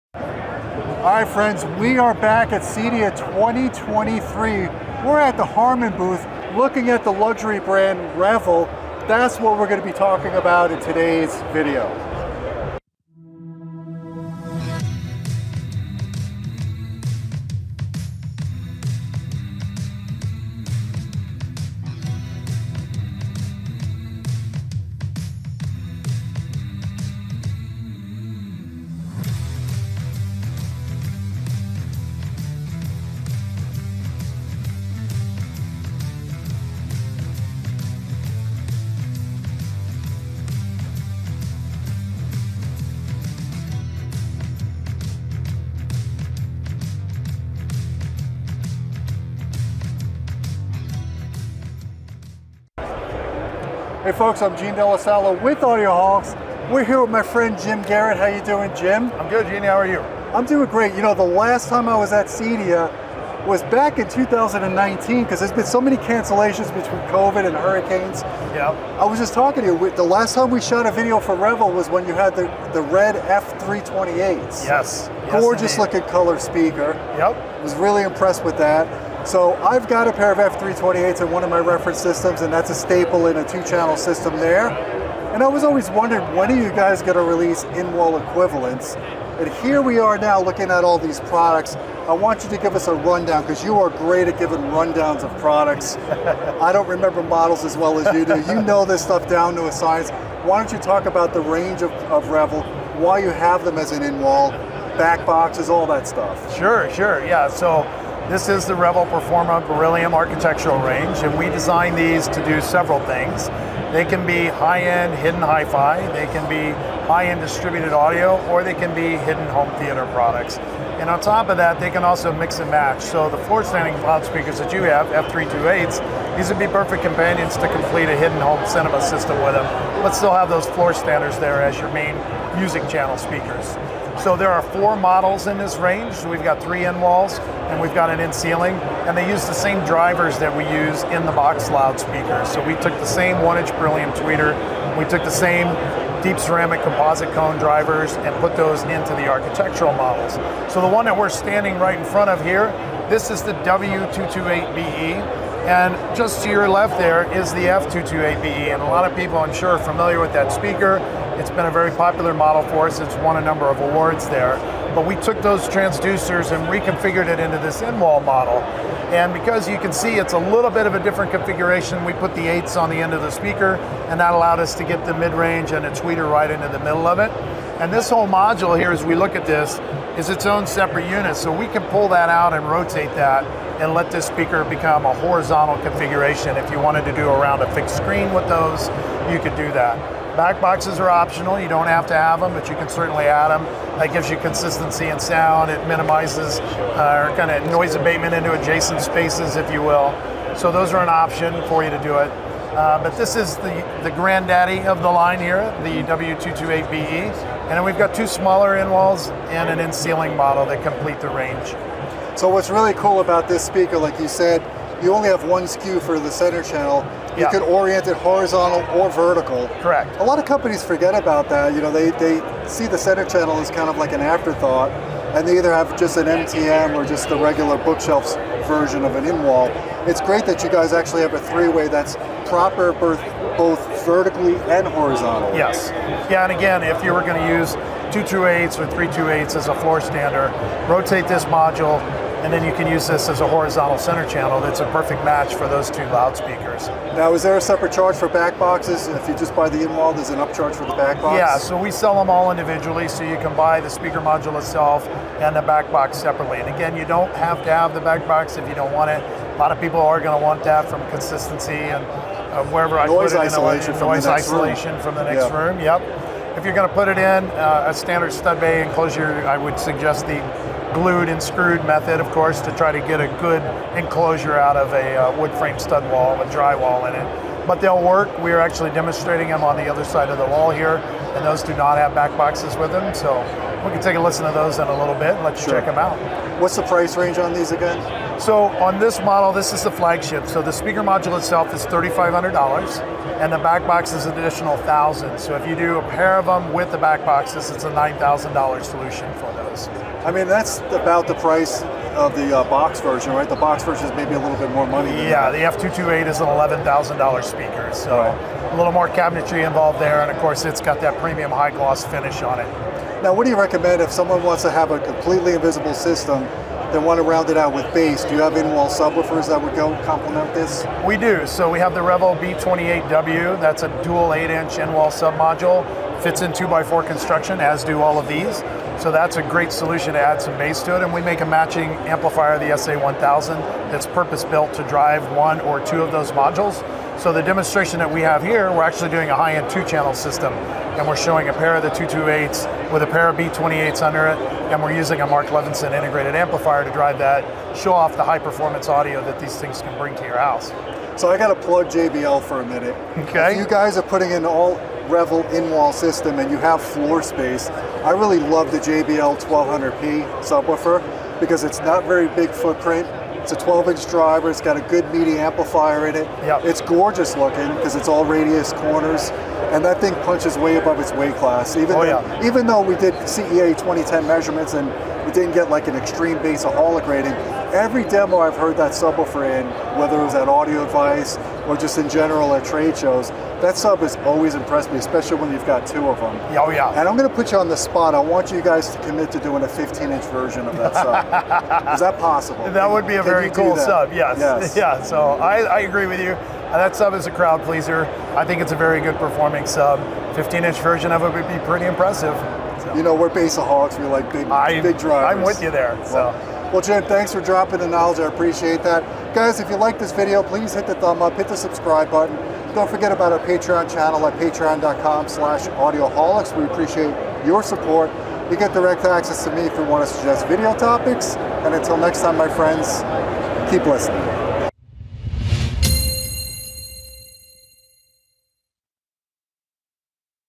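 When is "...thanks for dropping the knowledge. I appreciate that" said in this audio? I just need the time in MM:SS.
06:47.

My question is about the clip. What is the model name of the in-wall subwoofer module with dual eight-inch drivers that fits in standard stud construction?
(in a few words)
B28W.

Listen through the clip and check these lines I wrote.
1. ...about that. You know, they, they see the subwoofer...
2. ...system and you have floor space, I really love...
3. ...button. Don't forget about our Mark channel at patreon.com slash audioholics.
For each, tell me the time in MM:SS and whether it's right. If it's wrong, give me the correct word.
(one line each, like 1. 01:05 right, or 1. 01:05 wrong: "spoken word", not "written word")
1. 03:41 wrong: "center", not "subwoofer"
2. 05:55 right
3. 06:52 wrong: "Patreon", not "Mark".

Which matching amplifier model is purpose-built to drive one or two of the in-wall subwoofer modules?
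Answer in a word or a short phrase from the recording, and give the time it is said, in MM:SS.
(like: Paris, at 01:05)
SA1000, at 05:32.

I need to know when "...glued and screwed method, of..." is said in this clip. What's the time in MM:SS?
04:30.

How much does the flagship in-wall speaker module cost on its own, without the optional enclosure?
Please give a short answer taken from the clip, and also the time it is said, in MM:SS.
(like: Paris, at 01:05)
$3,500, at 04:51.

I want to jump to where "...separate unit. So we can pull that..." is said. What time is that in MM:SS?
03:00.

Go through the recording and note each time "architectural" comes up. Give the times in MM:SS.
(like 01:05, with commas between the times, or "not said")
01:50, 02:29.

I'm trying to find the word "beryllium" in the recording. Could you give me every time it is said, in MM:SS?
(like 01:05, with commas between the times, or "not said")
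01:49, 02:23.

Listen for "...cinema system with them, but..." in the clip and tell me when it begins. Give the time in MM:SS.
02:08.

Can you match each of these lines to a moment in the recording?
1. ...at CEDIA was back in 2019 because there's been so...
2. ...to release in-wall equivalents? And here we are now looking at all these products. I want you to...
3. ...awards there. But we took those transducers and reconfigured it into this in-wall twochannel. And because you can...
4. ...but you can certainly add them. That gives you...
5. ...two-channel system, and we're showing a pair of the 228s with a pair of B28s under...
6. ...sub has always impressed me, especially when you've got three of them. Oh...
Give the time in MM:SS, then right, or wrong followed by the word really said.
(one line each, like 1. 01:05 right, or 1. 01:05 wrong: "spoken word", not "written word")
1. 01:02 right
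2. 01:27 right
3. 02:43 wrong: "model", not "twochannel"
4. 03:12 right
5. 05:39 right
6. 06:23 wrong: "two", not "three".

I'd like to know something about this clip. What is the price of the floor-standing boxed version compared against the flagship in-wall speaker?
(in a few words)
$11,000.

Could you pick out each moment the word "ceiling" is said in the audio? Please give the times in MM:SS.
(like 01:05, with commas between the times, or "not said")
02:18, 03:29.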